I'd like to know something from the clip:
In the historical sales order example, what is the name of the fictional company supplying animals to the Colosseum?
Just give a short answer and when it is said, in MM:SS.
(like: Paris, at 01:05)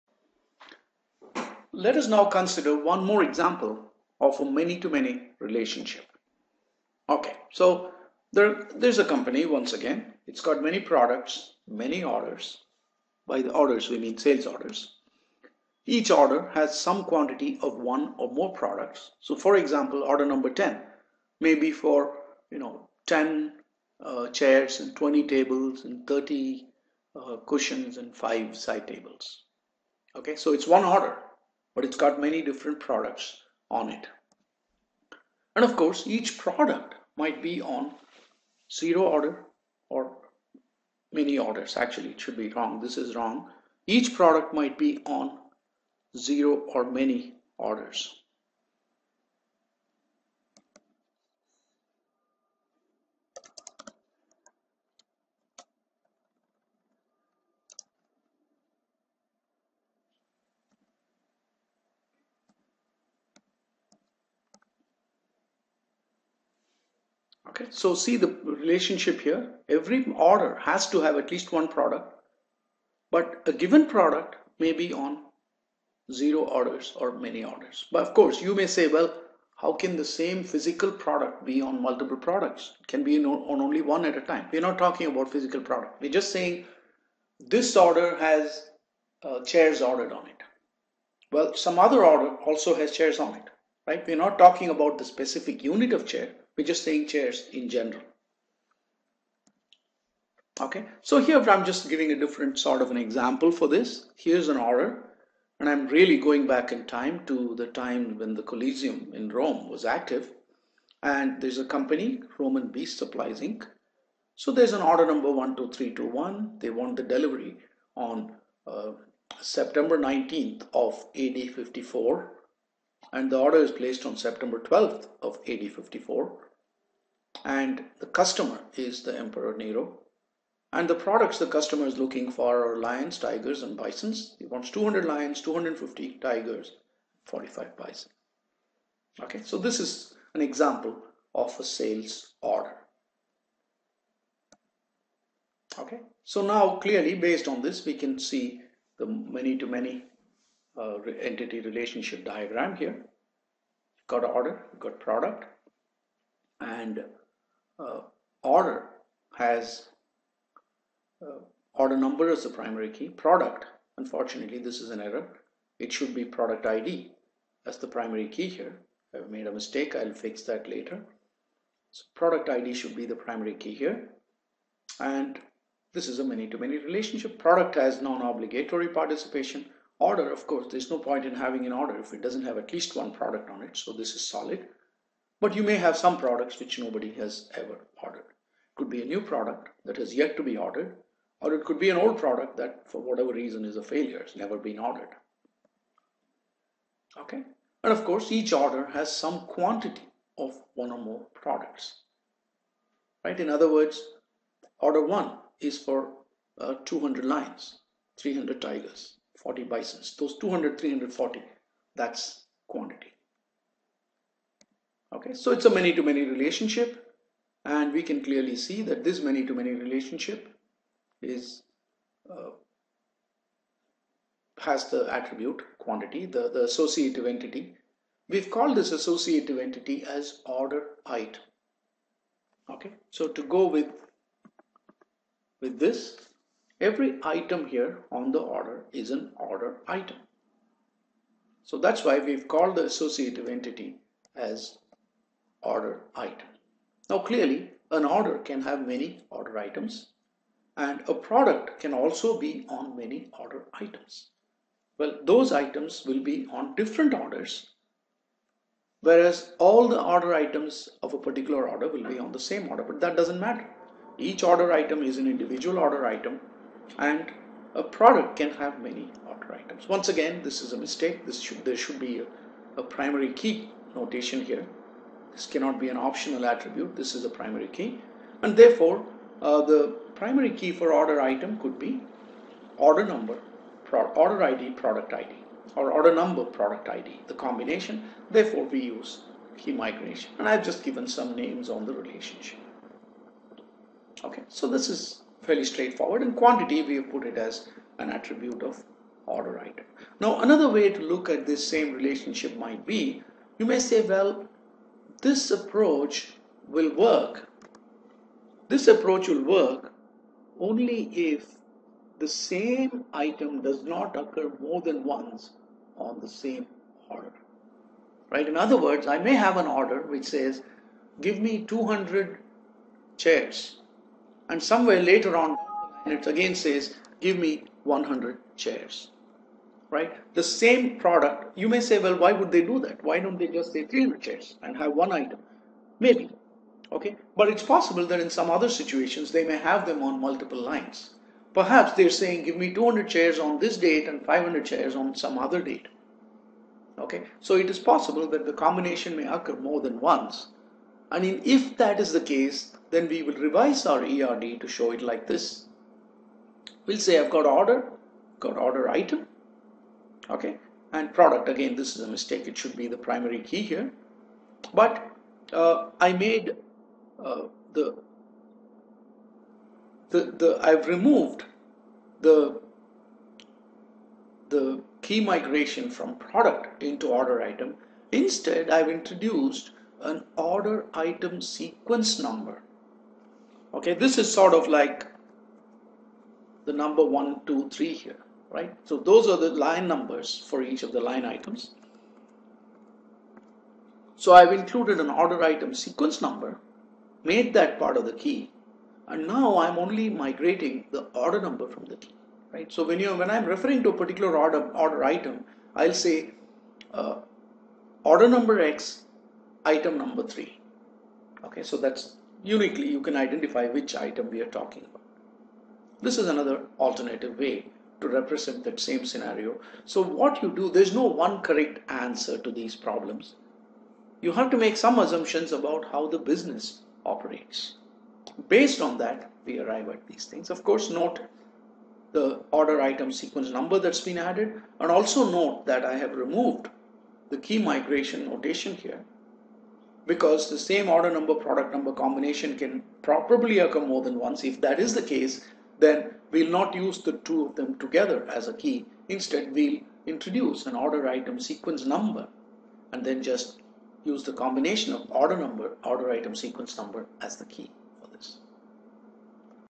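Roman Beast Supplies Inc., at 01:52.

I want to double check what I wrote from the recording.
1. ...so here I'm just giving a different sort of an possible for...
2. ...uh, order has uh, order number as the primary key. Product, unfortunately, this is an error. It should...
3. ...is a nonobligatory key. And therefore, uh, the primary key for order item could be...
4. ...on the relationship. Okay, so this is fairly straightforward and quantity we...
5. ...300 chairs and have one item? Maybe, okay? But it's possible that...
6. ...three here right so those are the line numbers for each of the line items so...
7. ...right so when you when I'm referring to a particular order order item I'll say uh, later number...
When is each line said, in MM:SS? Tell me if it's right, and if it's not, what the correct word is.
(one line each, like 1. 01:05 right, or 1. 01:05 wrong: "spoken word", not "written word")
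1. 01:41 wrong: "example", not "possible"
2. 02:37 right
3. 04:37 wrong: "primary", not "nonobligatory"
4. 04:51 right
5. 05:33 right
6. 06:27 right
7. 06:42 wrong: "order", not "later".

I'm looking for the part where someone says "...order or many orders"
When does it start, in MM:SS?
00:39.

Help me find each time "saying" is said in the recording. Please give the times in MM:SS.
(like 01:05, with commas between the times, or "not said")
01:26, 01:36, 05:42.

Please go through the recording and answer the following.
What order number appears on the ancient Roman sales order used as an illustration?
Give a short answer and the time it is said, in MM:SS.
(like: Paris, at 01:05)
12321, at 01:55.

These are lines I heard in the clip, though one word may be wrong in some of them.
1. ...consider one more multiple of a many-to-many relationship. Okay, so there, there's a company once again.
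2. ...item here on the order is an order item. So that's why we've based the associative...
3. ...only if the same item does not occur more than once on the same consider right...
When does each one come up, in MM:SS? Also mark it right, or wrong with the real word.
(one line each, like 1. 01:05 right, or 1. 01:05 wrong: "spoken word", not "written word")
1. 00:02 wrong: "example", not "multiple"
2. 03:57 wrong: "called", not "based"
3. 05:10 wrong: "order", not "consider".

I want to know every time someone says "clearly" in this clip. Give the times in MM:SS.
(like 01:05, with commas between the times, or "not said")
02:26, 03:38, 04:07.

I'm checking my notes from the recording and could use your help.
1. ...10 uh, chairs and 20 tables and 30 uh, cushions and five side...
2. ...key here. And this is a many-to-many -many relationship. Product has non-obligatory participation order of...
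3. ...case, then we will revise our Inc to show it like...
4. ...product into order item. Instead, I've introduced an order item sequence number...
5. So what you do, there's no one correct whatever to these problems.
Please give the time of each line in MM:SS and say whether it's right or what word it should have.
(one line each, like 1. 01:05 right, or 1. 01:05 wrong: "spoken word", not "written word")
1. 00:23 right
2. 02:53 right
3. 05:52 wrong: "ERD", not "Inc"
4. 06:16 right
5. 06:59 wrong: "answer", not "whatever".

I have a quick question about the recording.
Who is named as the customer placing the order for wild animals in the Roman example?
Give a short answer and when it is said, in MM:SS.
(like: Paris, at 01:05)
Emperor Nero, at 02:09.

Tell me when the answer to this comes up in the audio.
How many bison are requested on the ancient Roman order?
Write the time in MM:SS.
02:17.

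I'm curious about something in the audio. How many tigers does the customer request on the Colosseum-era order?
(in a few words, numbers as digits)
250.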